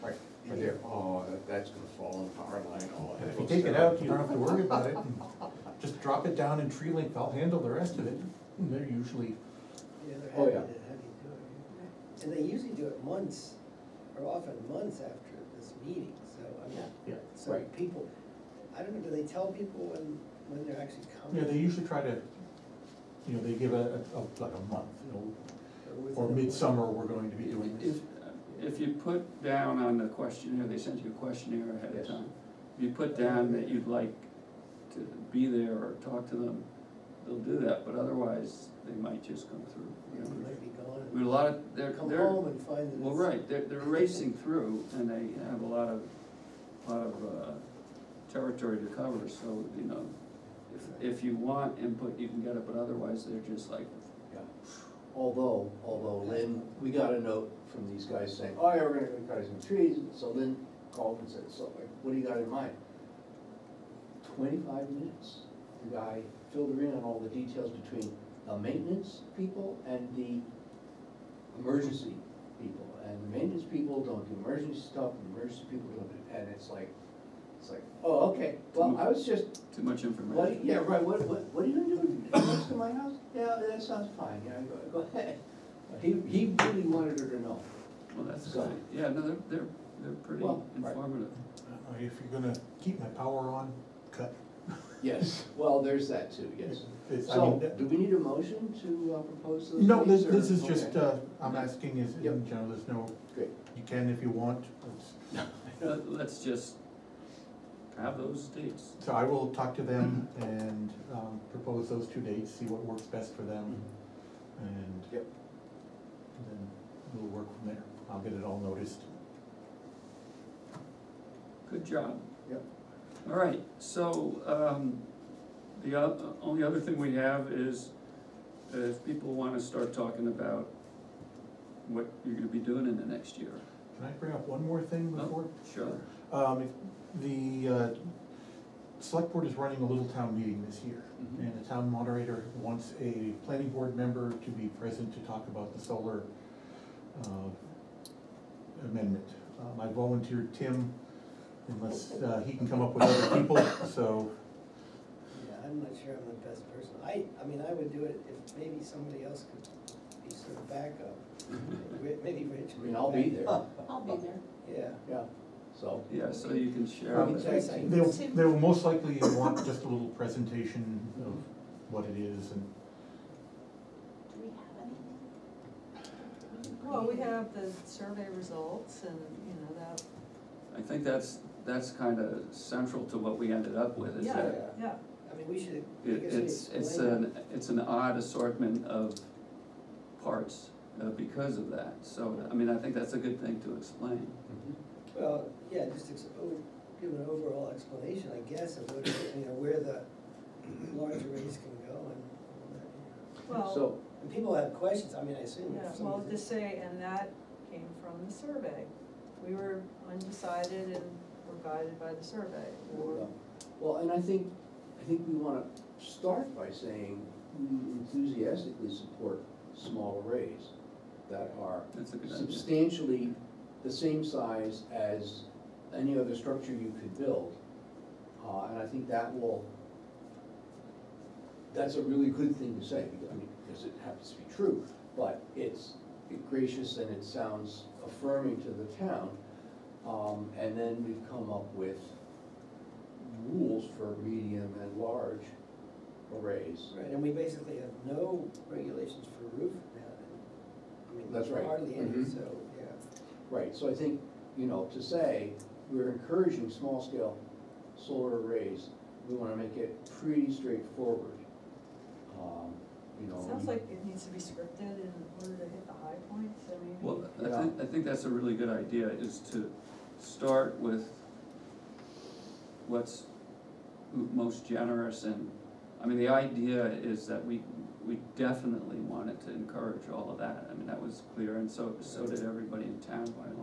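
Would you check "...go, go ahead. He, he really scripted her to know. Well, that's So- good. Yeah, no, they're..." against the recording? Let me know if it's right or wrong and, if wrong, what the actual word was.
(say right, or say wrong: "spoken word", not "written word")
wrong: "wanted", not "scripted".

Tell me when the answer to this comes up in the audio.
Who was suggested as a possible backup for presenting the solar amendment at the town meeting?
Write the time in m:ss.
2:42.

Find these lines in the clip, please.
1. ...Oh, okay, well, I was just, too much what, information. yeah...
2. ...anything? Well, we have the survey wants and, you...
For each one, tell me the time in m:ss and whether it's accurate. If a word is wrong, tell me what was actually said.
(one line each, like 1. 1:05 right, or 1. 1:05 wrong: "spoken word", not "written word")
1. 1:18 right
2. 2:56 wrong: "results", not "wants".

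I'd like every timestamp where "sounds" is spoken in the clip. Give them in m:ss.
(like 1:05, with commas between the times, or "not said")
1:23, 3:57, 4:23.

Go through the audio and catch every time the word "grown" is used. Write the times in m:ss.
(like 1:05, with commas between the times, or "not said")
not said.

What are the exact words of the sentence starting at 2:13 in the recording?
Can I bring up one more thing oh, before?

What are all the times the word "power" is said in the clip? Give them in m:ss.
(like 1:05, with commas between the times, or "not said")
0:02, 1:33.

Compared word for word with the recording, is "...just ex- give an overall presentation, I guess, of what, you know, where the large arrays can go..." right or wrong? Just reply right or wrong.
wrong.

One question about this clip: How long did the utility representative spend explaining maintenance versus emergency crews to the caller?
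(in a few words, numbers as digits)
25 minutes.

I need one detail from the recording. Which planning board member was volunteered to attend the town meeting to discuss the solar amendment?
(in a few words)
Tim.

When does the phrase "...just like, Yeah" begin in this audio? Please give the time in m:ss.
0:53.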